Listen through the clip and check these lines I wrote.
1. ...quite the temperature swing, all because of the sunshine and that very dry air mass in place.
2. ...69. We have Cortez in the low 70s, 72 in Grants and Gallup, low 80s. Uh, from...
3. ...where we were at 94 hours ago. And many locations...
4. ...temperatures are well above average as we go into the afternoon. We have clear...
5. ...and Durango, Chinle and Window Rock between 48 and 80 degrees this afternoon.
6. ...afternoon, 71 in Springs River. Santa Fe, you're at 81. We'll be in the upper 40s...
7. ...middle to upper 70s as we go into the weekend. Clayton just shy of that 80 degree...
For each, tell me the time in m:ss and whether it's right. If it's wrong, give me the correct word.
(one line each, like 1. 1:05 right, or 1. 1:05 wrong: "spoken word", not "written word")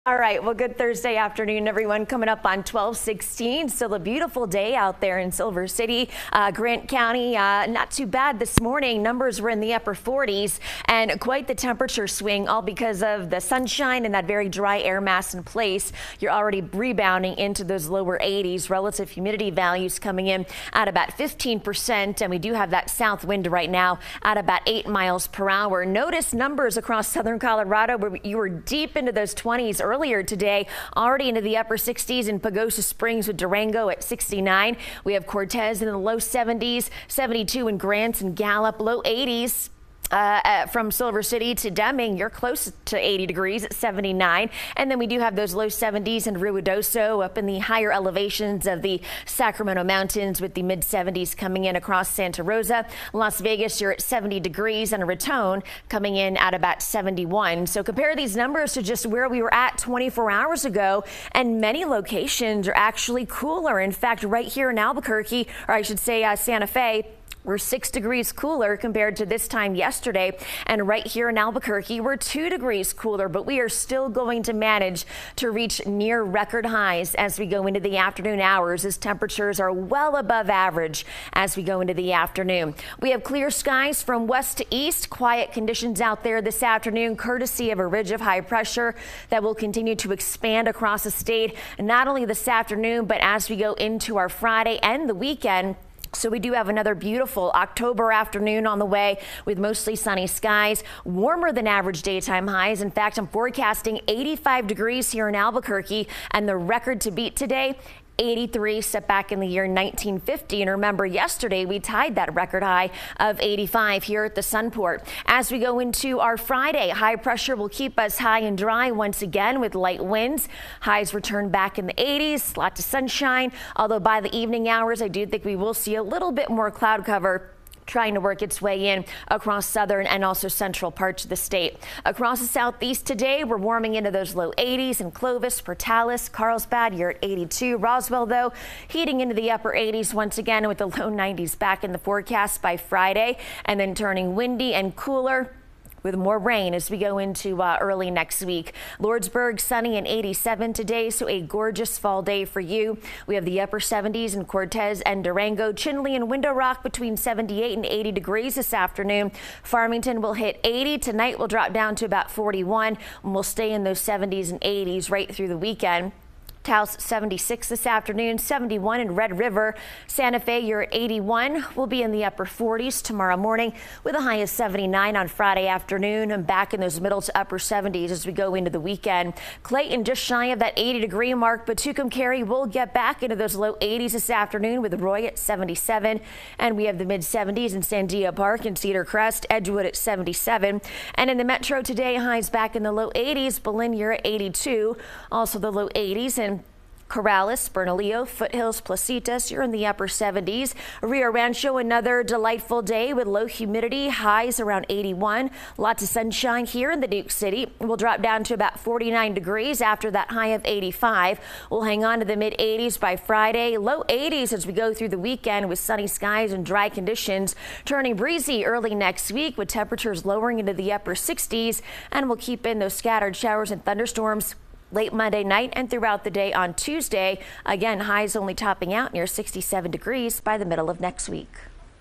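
1. 0:11 right
2. 0:34 right
3. 0:59 wrong: "24", not "94"
4. 1:18 right
5. 2:35 wrong: "78", not "48"
6. 2:47 wrong: "Red", not "Springs"
7. 2:57 right.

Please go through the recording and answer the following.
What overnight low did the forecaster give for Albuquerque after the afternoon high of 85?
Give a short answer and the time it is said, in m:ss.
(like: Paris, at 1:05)
49, at 3:28.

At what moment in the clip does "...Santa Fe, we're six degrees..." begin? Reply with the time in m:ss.
1:06.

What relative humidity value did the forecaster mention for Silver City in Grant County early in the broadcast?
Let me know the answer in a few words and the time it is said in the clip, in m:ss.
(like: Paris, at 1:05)
15%, at 0:21.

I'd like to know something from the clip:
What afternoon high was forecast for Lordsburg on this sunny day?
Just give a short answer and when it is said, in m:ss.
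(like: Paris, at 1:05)
87, at 2:30.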